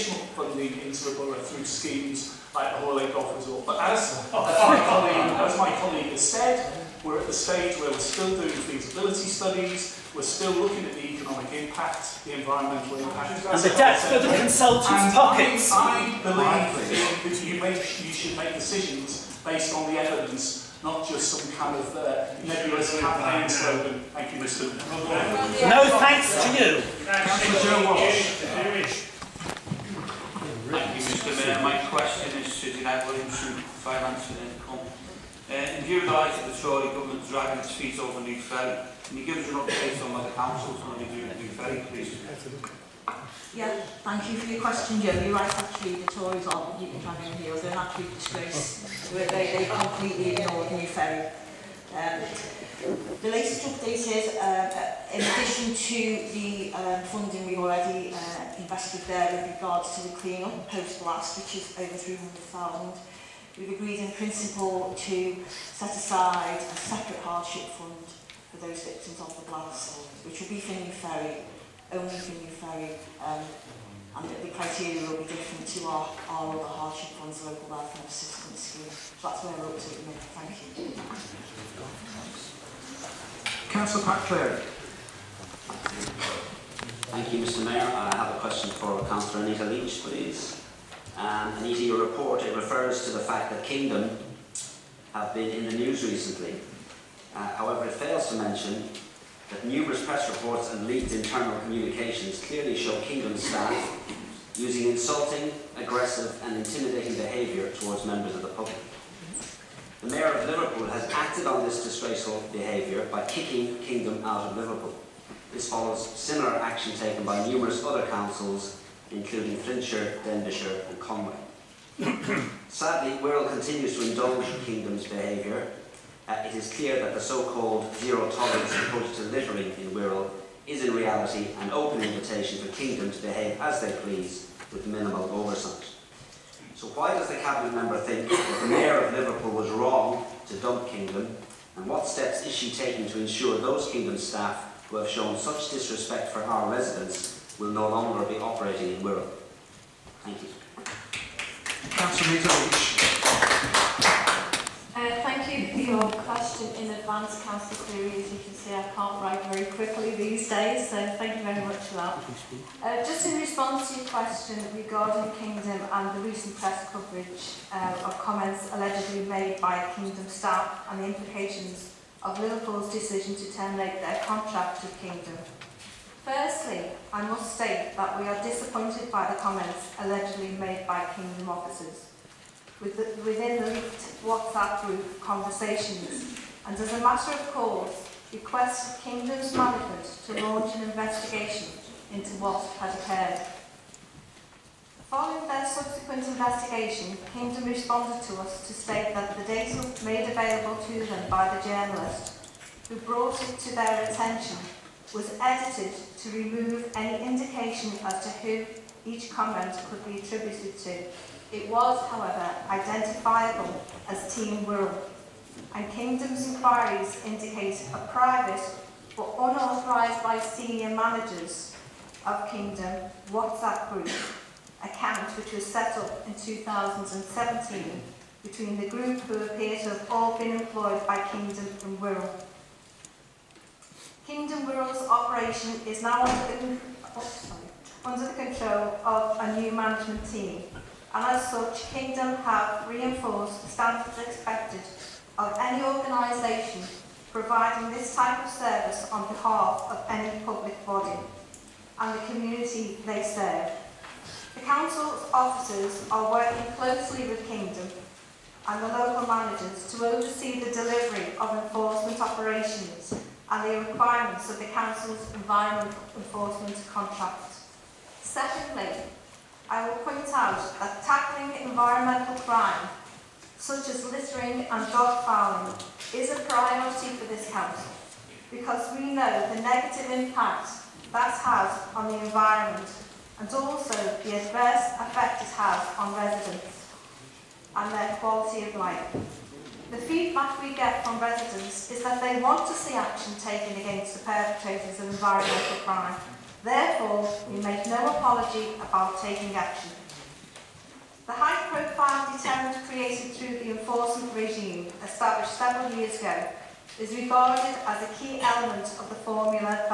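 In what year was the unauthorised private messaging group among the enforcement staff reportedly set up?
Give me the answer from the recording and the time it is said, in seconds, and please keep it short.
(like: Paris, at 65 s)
2017, at 226 s.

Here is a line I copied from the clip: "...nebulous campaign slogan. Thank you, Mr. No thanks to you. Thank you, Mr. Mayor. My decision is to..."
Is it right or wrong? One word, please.
wrong.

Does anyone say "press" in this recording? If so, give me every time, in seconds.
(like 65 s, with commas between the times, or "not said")
100 s, 166 s.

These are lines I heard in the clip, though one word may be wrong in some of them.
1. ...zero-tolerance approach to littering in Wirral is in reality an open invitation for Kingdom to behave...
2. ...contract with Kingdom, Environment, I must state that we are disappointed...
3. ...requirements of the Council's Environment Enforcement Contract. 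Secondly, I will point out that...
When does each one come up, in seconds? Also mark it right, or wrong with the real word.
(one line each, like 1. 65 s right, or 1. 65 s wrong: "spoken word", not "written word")
1. 127 s right
2. 174 s wrong: "Firstly", not "Environment"
3. 263 s right.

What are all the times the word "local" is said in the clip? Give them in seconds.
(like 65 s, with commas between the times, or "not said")
77 s, 258 s.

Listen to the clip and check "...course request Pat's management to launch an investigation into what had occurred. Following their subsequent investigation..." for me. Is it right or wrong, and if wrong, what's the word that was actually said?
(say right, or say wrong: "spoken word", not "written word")
wrong: "Kingdom", not "Pat".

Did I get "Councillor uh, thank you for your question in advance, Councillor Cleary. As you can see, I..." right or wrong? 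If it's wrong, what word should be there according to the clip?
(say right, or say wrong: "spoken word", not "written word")
right.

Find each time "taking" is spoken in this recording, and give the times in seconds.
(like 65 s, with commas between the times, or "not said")
142 s, 299 s.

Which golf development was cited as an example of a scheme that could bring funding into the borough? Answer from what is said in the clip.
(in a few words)
Hoyle Golf Resort.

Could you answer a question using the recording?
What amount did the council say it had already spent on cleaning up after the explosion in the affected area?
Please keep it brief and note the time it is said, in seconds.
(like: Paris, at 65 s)
over 300,000, at 61 s.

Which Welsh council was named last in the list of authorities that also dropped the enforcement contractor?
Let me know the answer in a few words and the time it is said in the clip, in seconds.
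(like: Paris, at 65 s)
Conwy, at 120 s.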